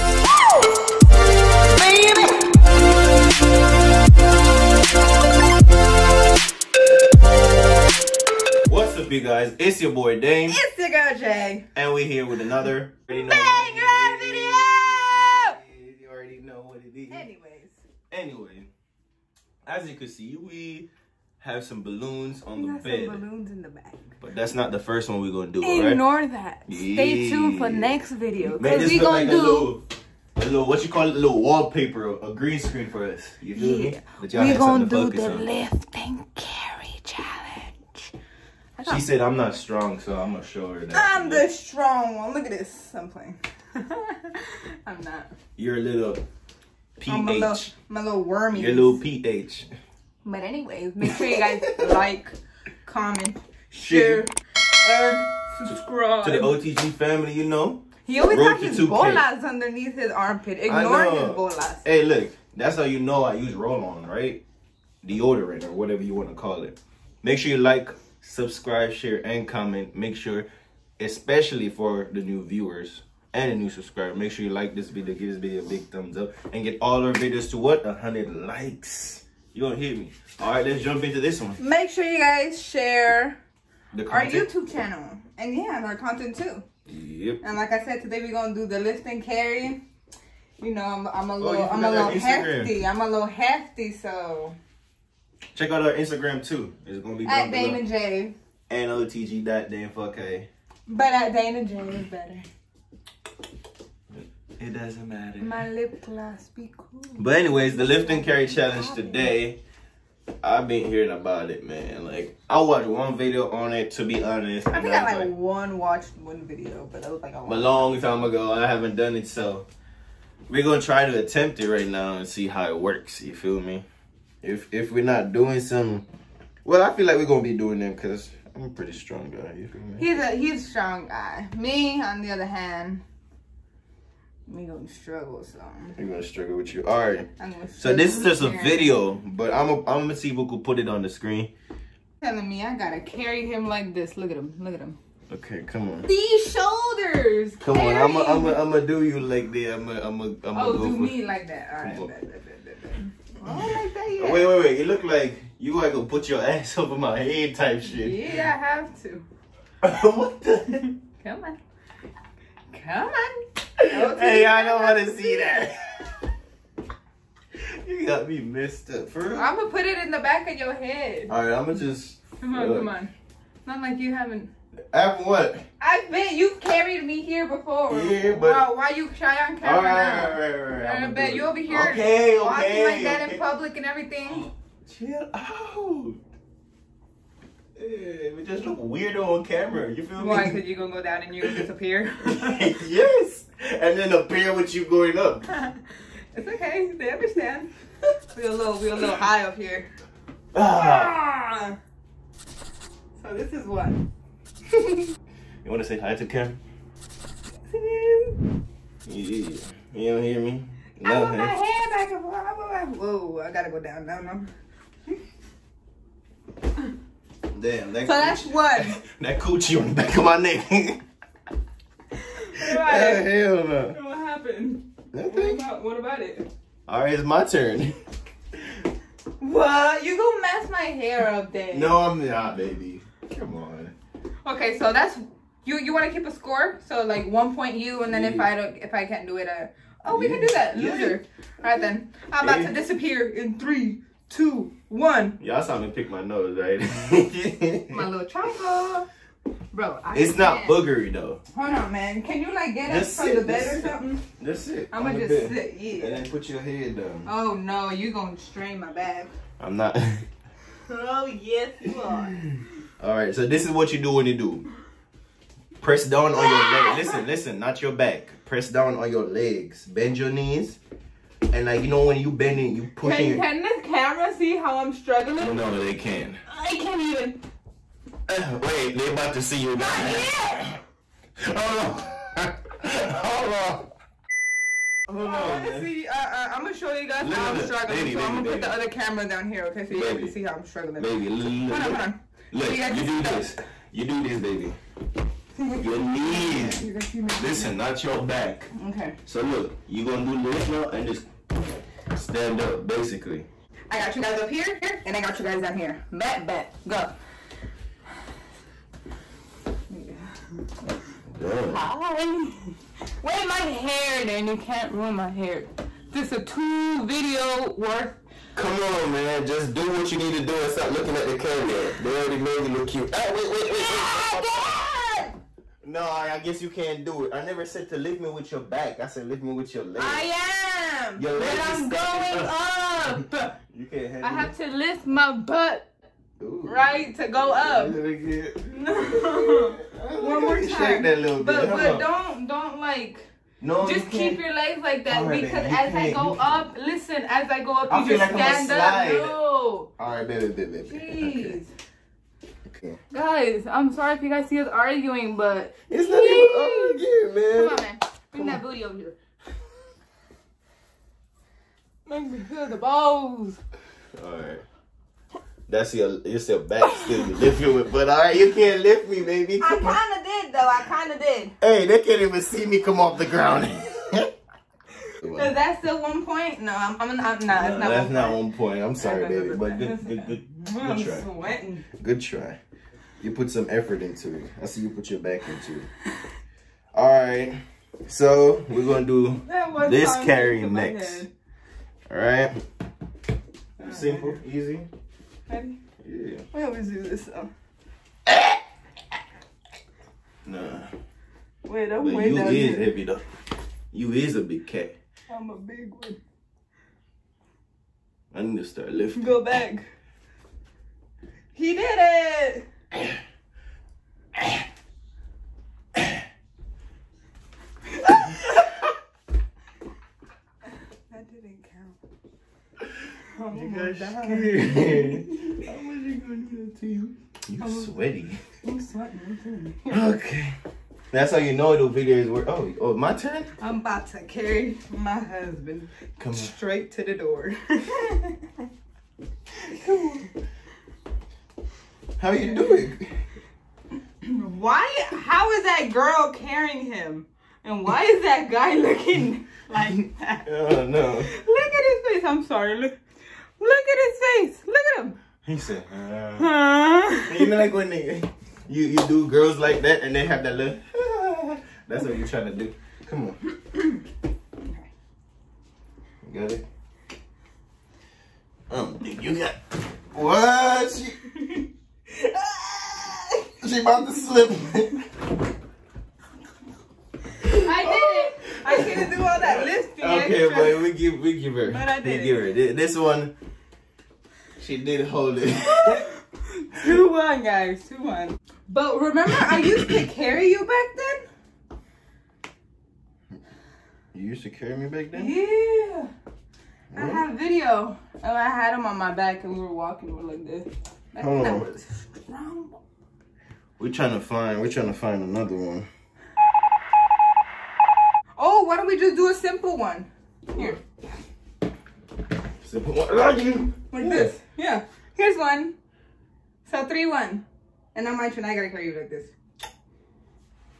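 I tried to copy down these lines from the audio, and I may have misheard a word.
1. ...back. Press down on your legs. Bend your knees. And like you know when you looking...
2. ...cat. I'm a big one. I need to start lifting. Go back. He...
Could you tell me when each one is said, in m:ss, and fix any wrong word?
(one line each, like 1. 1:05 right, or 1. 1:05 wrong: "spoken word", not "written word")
1. 4:27 wrong: "bending", not "looking"
2. 6:44 right.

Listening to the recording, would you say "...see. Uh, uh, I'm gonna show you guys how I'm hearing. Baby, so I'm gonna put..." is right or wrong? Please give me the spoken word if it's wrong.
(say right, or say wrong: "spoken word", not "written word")
wrong: "struggling", not "hearing".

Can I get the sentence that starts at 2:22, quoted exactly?
Telling me I gotta carry him like this.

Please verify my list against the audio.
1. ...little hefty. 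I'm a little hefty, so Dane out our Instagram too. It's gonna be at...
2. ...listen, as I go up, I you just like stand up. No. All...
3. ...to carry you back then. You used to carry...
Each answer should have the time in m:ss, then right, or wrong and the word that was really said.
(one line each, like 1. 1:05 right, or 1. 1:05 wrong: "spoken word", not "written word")
1. 1:31 wrong: "Check", not "Dane"
2. 5:46 right
3. 8:09 right.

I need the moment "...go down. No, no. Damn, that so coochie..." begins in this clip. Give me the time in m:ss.
3:33.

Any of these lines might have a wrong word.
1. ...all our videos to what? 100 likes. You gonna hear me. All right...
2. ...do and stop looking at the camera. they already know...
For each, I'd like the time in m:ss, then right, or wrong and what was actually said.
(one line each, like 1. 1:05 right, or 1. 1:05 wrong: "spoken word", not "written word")
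1. 1:16 right
2. 5:20 right.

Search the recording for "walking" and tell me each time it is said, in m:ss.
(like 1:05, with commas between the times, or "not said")
3:02, 8:19.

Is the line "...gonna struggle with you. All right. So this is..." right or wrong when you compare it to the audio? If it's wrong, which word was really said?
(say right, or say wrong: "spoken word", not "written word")
right.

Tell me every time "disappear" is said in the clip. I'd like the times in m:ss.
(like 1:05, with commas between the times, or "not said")
3:11, 4:02.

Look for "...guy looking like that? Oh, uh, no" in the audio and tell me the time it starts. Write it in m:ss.
7:28.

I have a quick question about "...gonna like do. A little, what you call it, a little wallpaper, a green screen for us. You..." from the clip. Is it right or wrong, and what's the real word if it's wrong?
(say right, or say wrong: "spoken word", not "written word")
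right.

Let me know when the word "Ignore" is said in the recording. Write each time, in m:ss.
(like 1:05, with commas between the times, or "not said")
0:25, 1:00.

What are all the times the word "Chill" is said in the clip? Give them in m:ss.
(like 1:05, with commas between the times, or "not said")
3:04.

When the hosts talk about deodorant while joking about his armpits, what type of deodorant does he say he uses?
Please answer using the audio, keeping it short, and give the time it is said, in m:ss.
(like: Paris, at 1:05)
roll-on, at 1:03.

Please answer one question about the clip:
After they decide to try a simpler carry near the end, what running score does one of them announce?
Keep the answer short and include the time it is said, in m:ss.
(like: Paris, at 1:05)
3-1, at 8:36.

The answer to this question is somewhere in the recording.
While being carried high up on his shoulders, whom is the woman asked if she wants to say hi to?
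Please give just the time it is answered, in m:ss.
3:26.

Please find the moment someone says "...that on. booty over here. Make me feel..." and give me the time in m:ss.
5:58.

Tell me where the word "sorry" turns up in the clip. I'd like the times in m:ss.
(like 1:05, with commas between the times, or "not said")
5:53, 6:18, 7:32.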